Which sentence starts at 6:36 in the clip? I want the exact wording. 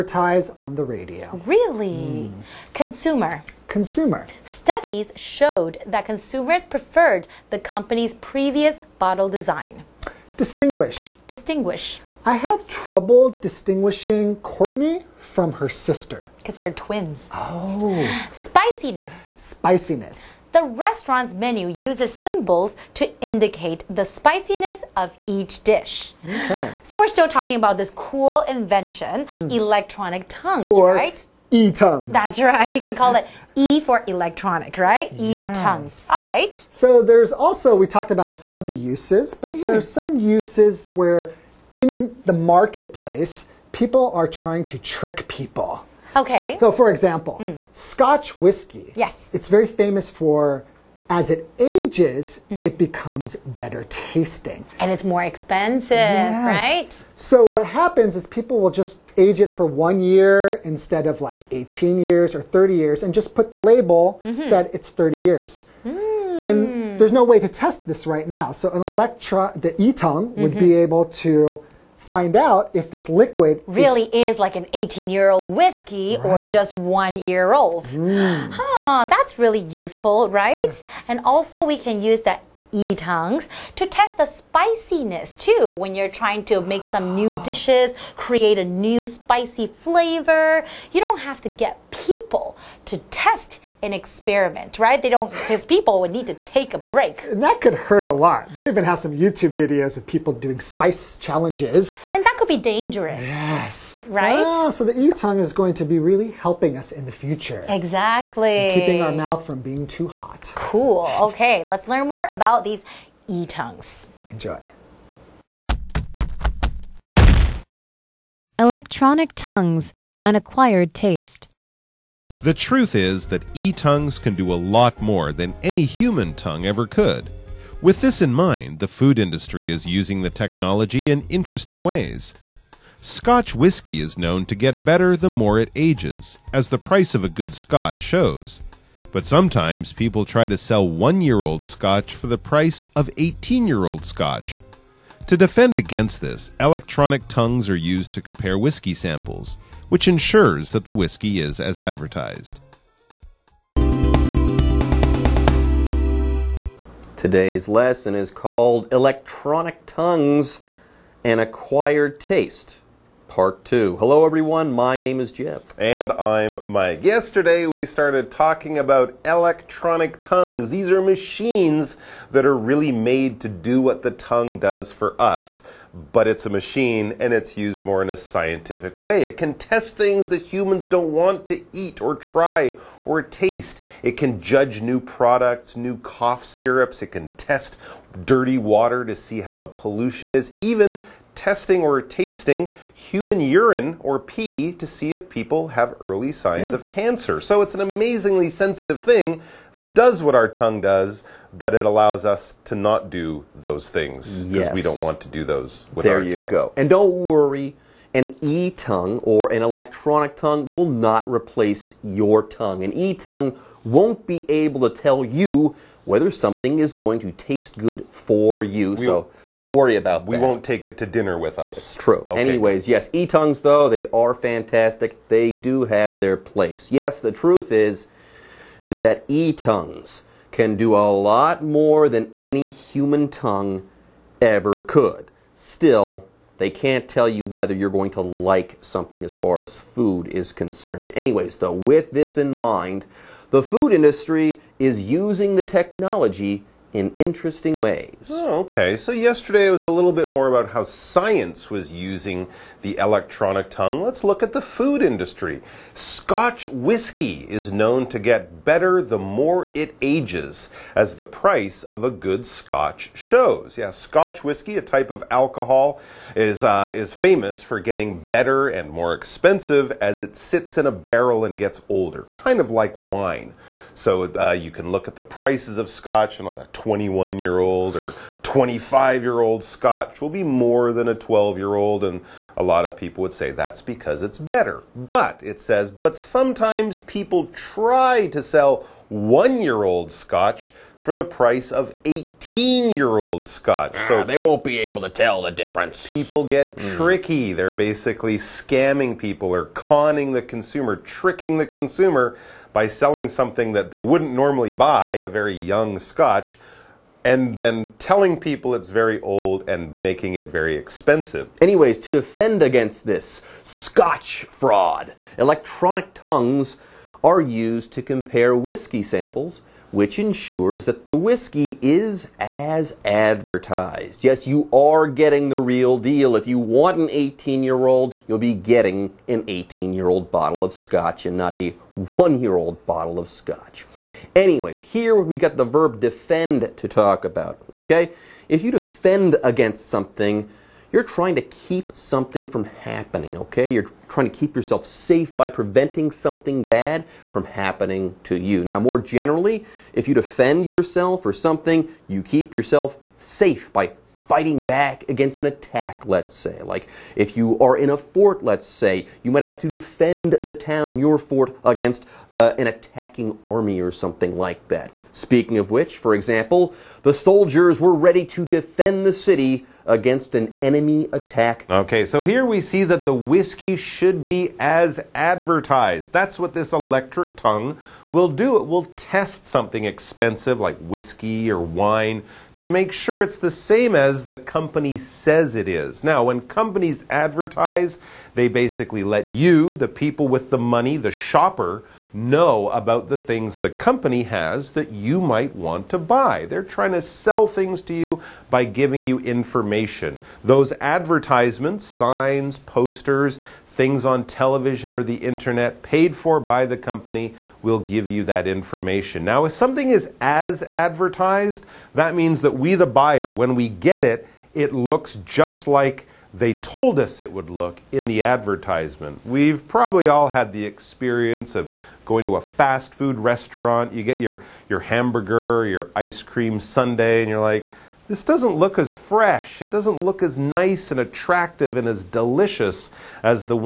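They're trying to sell things to you by giving you information.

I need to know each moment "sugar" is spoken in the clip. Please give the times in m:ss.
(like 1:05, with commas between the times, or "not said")
not said.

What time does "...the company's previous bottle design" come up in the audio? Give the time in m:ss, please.
0:07.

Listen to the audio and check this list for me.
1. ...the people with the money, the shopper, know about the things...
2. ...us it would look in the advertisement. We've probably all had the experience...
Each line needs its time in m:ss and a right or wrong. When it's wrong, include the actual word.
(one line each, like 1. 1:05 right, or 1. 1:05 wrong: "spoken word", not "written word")
1. 6:29 right
2. 6:56 right.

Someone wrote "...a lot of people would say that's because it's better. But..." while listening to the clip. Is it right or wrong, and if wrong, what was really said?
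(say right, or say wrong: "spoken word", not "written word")
right.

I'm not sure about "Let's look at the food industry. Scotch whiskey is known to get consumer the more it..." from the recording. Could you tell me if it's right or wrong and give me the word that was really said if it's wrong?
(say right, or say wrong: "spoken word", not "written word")
wrong: "better", not "consumer".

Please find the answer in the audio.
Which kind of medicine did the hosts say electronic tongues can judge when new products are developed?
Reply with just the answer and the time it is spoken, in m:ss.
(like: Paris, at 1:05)
cough syrups, at 3:05.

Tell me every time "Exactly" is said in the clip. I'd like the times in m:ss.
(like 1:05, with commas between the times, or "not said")
1:47.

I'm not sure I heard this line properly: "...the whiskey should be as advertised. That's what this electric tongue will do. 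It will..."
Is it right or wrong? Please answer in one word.
right.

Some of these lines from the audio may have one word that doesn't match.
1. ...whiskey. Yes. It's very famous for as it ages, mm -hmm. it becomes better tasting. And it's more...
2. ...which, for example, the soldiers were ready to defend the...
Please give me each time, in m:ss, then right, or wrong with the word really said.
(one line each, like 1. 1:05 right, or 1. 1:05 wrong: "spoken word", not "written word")
1. 0:48 right
2. 6:05 right.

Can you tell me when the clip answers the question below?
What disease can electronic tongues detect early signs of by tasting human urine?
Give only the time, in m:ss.
3:16.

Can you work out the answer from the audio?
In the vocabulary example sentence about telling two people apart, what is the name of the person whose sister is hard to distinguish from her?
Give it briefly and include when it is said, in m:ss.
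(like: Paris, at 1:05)
Courtney, at 0:14.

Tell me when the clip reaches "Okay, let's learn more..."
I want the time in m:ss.
1:51.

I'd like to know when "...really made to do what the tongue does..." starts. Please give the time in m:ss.
2:52.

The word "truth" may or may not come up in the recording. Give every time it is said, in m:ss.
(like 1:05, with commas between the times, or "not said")
2:02, 3:47.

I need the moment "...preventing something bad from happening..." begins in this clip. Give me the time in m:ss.
5:45.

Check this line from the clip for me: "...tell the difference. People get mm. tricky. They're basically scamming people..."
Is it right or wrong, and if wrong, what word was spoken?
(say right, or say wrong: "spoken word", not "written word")
right.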